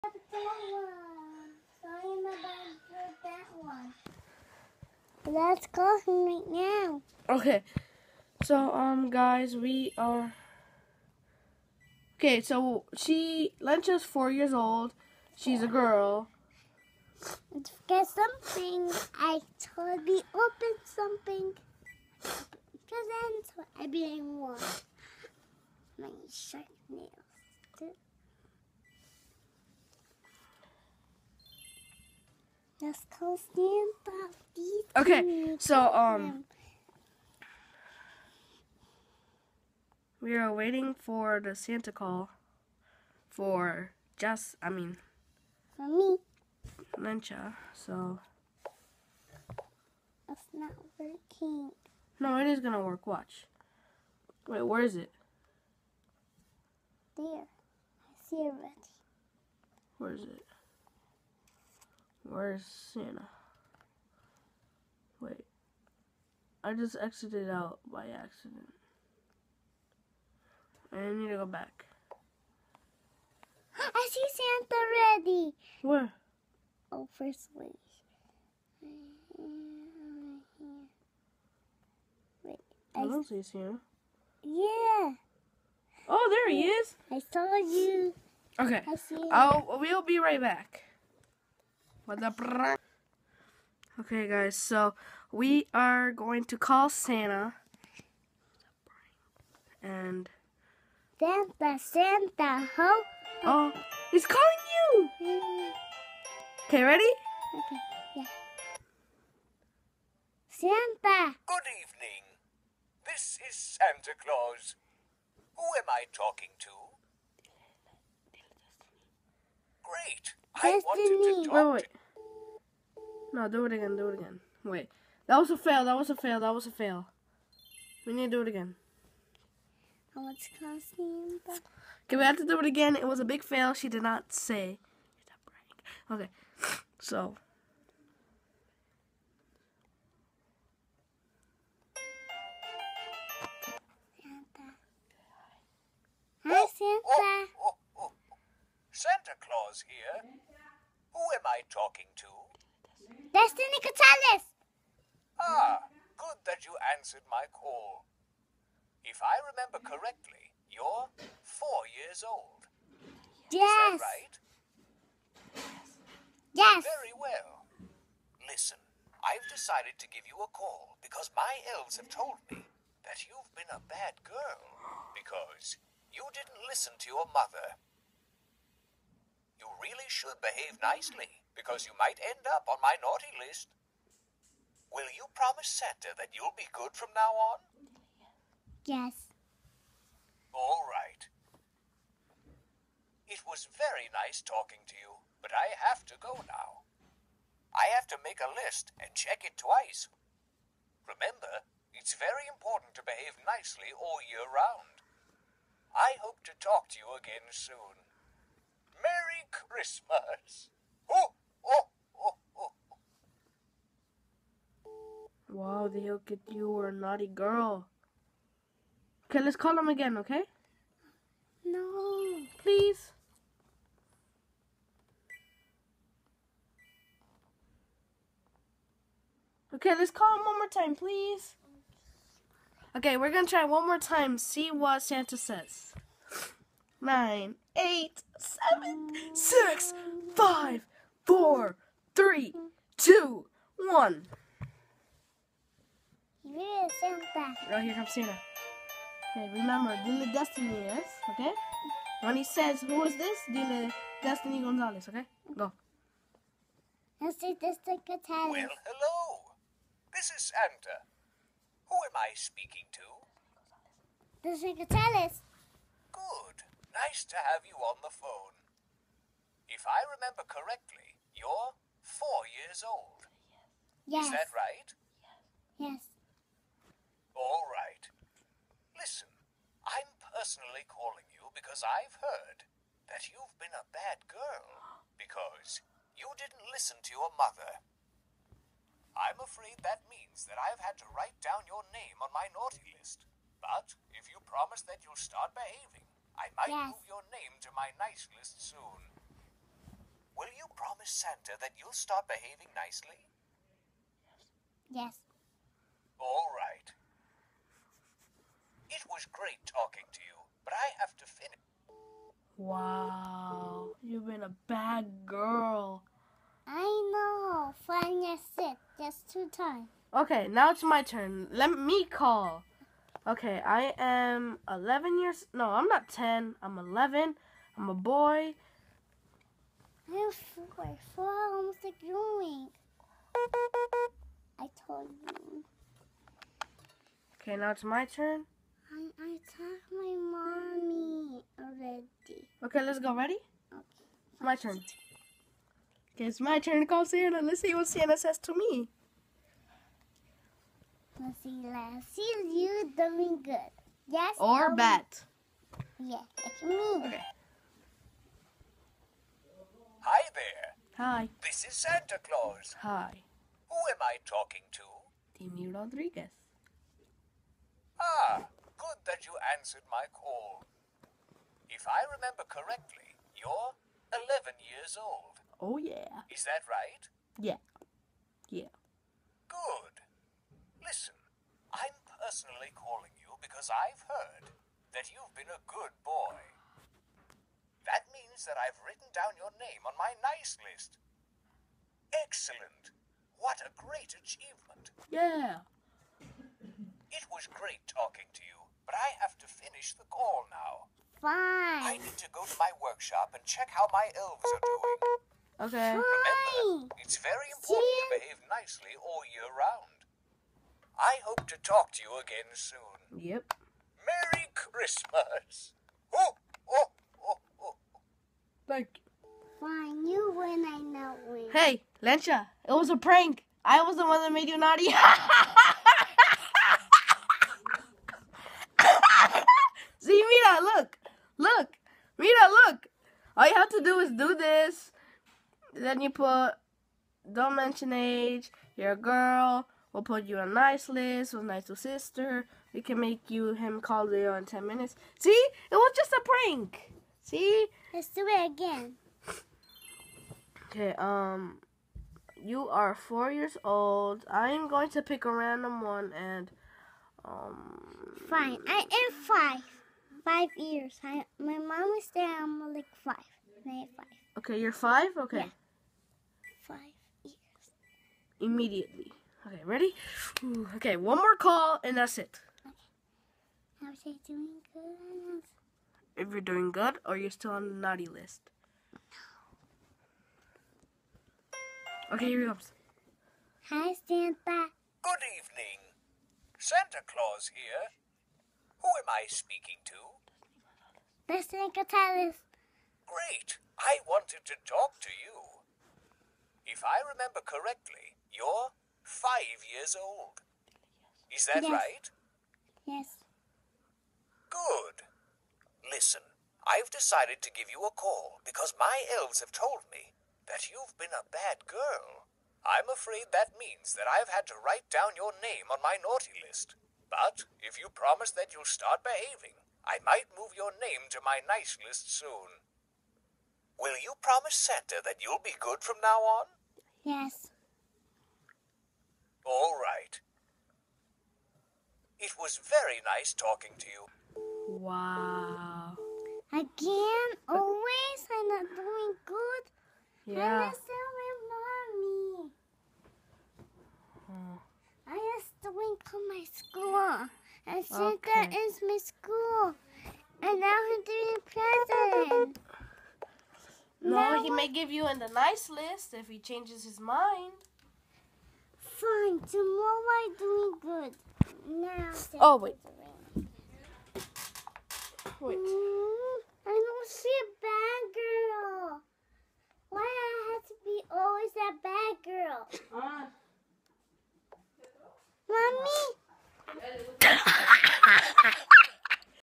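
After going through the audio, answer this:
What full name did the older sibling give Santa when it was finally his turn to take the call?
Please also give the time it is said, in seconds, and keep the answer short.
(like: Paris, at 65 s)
Timmy Rodriguez, at 365 s.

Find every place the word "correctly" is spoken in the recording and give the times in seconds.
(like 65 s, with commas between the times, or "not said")
159 s, 270 s, 372 s, 497 s.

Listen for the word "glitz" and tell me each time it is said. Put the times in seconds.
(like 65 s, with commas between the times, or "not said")
not said.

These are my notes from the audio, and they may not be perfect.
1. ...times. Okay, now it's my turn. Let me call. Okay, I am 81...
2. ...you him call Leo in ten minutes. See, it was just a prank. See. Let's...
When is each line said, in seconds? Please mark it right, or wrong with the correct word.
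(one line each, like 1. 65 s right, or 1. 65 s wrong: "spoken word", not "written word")
1. 319 s wrong: "11", not "81"
2. 443 s right.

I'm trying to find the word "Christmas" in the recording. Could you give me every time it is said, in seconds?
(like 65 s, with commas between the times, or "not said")
209 s, 414 s.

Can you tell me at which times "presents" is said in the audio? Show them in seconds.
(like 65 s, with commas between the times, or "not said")
22 s, 552 s.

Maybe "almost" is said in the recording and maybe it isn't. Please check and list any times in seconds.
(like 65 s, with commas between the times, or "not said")
331 s.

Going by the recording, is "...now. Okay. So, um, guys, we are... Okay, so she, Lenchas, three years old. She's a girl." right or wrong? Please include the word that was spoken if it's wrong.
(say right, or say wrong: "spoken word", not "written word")
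wrong: "four", not "three".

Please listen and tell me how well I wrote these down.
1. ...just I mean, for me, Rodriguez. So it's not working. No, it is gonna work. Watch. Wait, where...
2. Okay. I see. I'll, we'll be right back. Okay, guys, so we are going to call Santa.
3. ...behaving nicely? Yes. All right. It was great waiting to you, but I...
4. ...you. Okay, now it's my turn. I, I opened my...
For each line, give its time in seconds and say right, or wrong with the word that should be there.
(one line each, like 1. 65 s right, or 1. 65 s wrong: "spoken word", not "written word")
1. 44 s wrong: "Lencha", not "Rodriguez"
2. 88 s right
3. 302 s wrong: "talking", not "waiting"
4. 335 s wrong: "talked", not "opened".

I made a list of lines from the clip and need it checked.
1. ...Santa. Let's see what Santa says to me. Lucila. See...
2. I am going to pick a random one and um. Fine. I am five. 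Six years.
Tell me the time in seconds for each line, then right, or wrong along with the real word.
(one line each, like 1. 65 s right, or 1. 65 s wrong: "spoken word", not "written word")
1. 347 s right
2. 454 s wrong: "Five", not "Six".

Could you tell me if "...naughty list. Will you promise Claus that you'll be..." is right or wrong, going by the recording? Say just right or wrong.
wrong.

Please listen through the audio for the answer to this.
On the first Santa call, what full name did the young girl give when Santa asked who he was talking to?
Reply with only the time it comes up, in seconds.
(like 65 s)
153 s.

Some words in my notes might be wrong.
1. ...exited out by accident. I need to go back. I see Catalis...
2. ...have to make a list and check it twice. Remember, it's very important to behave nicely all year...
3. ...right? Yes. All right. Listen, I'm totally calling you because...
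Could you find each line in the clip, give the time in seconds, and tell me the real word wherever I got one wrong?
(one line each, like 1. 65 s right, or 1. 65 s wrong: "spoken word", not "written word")
1. 67 s wrong: "Santa", not "Catalis"
2. 197 s right
3. 274 s wrong: "personally", not "totally".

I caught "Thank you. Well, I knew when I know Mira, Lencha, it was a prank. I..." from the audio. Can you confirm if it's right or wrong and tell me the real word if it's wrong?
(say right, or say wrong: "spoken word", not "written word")
wrong: "Hey", not "Mira".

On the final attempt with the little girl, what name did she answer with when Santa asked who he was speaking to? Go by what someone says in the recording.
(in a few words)
Mr. Nicotales.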